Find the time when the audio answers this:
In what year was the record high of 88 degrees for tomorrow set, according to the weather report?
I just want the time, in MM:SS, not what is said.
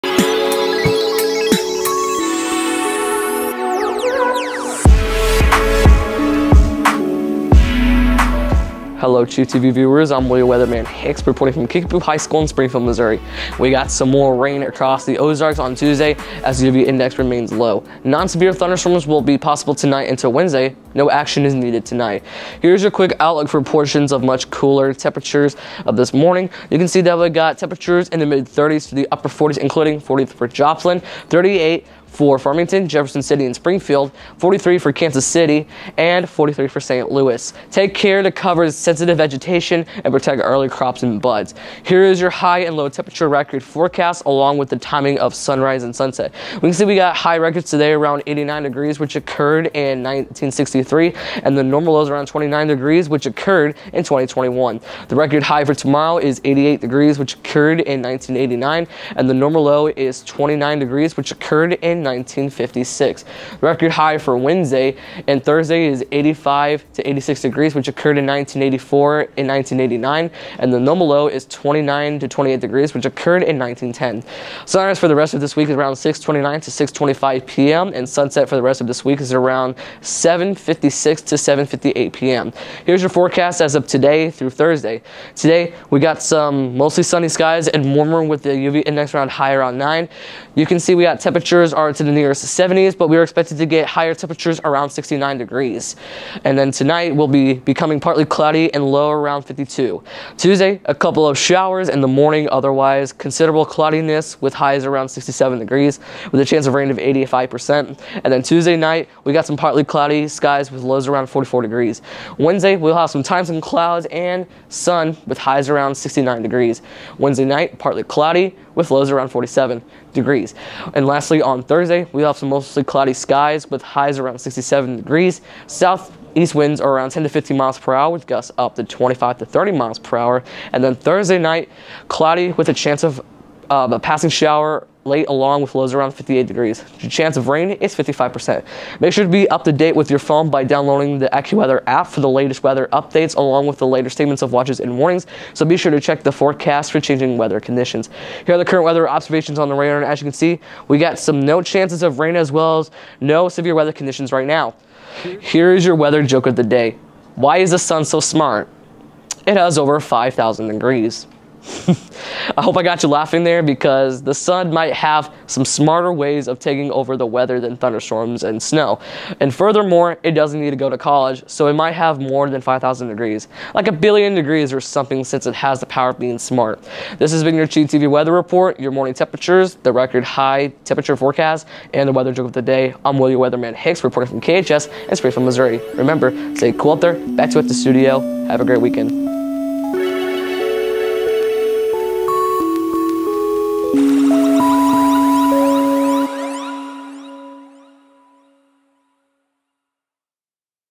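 00:56.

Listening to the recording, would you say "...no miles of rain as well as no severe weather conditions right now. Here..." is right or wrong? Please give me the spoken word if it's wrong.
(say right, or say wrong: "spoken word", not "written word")
wrong: "chances", not "miles".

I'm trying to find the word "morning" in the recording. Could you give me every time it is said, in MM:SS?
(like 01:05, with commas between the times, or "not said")
00:26, 01:42, 02:58.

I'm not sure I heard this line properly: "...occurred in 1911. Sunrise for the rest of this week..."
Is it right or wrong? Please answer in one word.
wrong.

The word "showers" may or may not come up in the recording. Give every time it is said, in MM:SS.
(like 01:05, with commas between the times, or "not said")
01:41, 02:14.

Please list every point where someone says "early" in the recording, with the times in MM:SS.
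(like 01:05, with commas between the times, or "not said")
00:40.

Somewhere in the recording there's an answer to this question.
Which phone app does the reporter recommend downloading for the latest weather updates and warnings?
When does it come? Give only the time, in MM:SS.
02:21.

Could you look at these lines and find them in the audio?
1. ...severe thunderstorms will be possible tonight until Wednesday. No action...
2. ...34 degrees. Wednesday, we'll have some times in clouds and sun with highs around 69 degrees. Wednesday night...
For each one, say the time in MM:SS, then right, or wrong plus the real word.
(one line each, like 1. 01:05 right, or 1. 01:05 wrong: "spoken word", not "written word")
1. 00:18 right
2. 01:51 wrong: "44", not "34".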